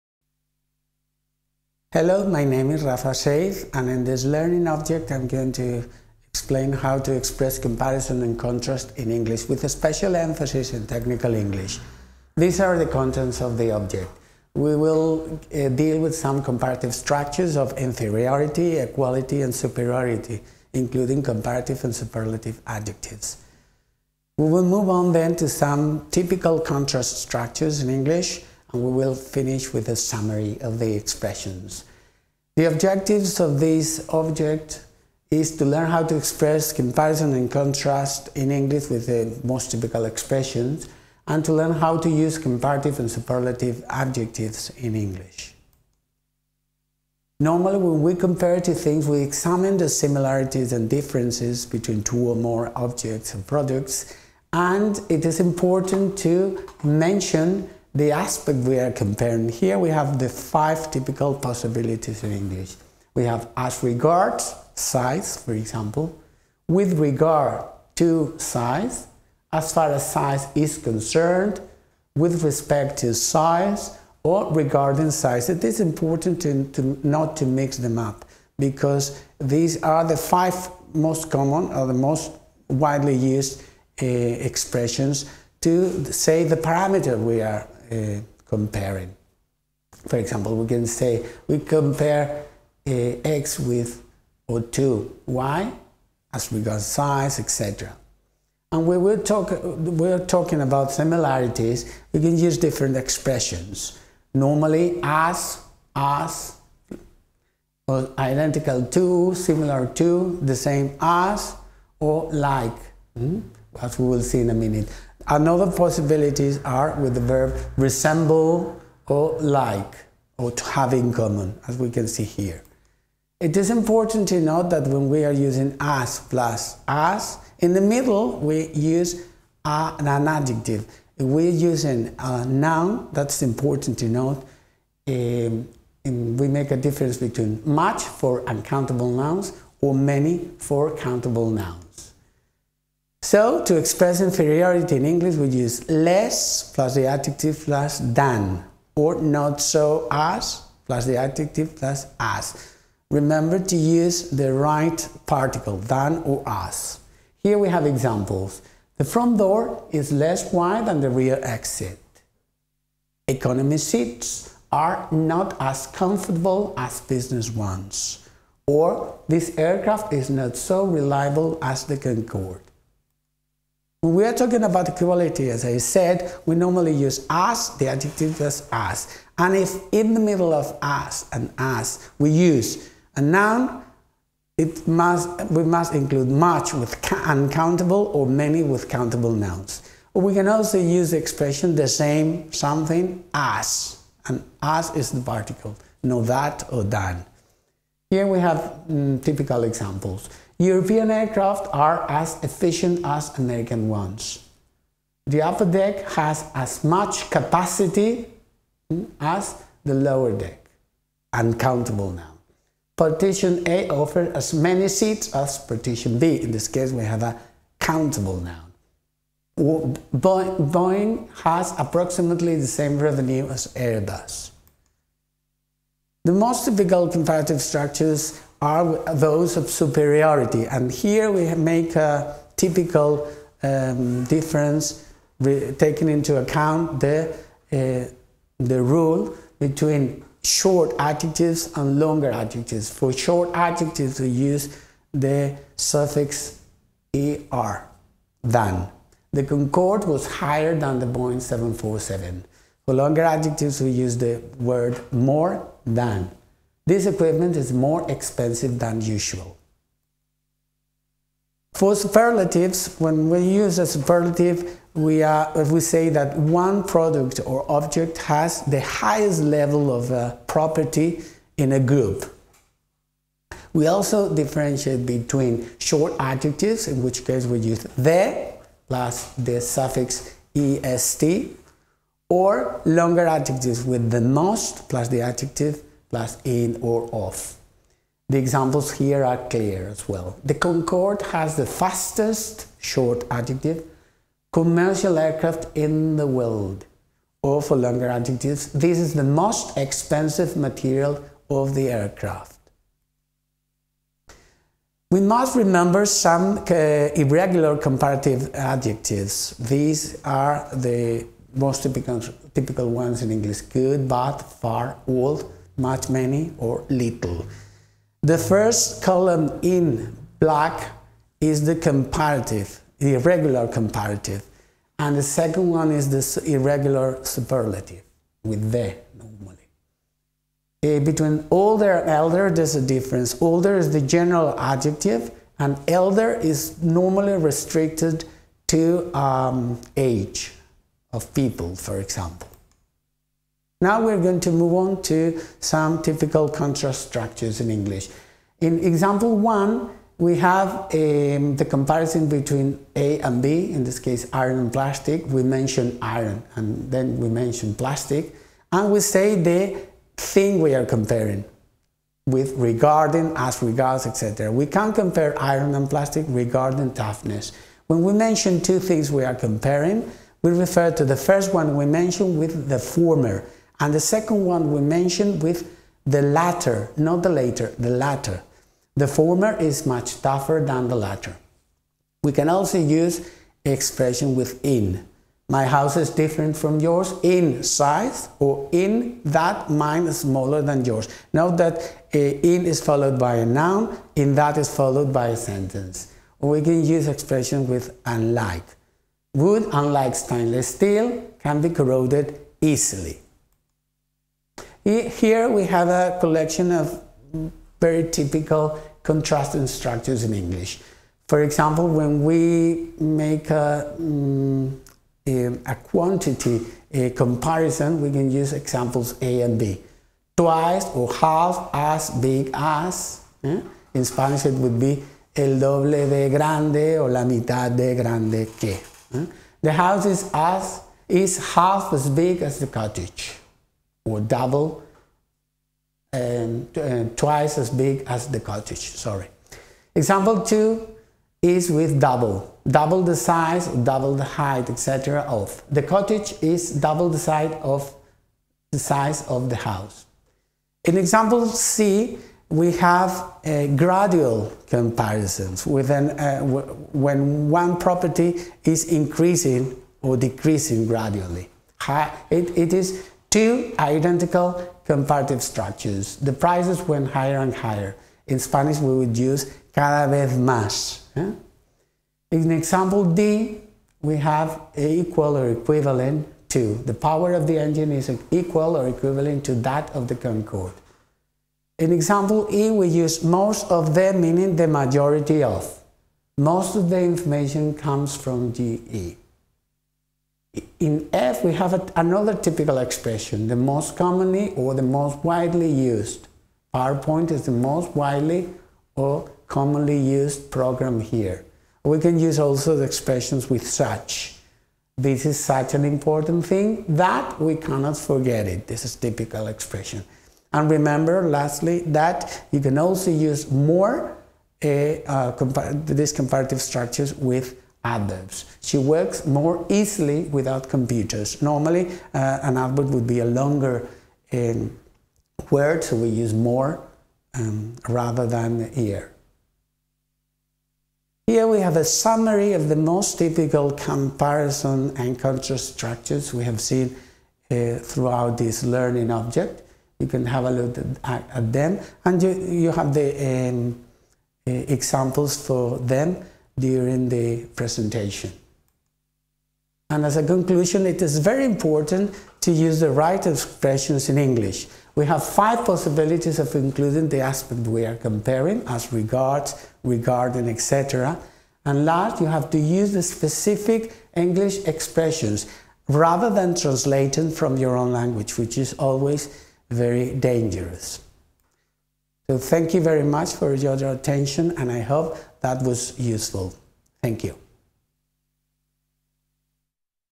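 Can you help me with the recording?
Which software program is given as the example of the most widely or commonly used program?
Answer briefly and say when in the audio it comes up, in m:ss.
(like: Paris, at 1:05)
PowerPoint, at 8:16.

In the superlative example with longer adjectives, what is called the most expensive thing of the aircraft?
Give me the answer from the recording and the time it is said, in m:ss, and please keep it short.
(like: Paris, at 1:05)
material, at 5:00.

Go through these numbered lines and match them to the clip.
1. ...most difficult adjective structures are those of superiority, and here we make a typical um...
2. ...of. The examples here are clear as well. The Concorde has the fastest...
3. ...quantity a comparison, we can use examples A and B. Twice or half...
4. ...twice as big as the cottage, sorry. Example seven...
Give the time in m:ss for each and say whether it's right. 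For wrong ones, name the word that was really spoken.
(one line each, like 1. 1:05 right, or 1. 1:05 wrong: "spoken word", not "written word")
1. 3:46 wrong: "comparative", not "adjective"
2. 4:47 right
3. 6:55 right
4. 7:17 wrong: "two", not "seven".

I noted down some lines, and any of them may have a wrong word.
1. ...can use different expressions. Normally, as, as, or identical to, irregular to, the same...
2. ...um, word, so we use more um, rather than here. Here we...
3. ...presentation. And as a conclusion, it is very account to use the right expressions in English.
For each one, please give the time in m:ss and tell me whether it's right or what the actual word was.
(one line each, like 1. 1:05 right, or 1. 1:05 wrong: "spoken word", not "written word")
1. 1:42 wrong: "similar", not "irregular"
2. 8:44 right
3. 9:07 wrong: "important", not "account".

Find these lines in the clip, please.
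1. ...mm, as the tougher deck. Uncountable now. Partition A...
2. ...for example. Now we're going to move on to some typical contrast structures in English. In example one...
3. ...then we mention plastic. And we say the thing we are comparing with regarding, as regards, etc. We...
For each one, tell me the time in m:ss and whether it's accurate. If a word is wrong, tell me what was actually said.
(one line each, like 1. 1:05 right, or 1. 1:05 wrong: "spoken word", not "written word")
1. 3:28 wrong: "lower", not "tougher"
2. 5:41 right
3. 5:56 right.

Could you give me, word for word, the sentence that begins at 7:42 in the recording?
It, it is two identical comparative structures.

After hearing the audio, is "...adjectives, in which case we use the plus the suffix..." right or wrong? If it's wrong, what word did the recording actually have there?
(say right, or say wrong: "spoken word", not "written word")
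right.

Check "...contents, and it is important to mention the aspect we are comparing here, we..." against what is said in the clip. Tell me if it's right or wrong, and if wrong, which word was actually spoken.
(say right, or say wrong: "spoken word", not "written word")
wrong: "products", not "contents".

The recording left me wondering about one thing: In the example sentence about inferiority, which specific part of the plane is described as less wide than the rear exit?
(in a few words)
The front door.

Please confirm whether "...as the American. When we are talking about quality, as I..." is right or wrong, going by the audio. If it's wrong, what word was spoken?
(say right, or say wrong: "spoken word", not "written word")
wrong: "Concorde", not "American".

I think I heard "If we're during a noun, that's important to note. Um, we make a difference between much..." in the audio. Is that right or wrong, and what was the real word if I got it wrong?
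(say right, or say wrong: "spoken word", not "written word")
wrong: "using", not "during".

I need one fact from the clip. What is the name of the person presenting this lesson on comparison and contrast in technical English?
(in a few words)
Rafa Seiz.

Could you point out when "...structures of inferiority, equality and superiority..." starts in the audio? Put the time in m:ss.
0:16.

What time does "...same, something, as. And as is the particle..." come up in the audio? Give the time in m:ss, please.
3:11.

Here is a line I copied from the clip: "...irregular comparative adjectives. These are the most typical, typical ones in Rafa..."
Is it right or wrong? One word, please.
wrong.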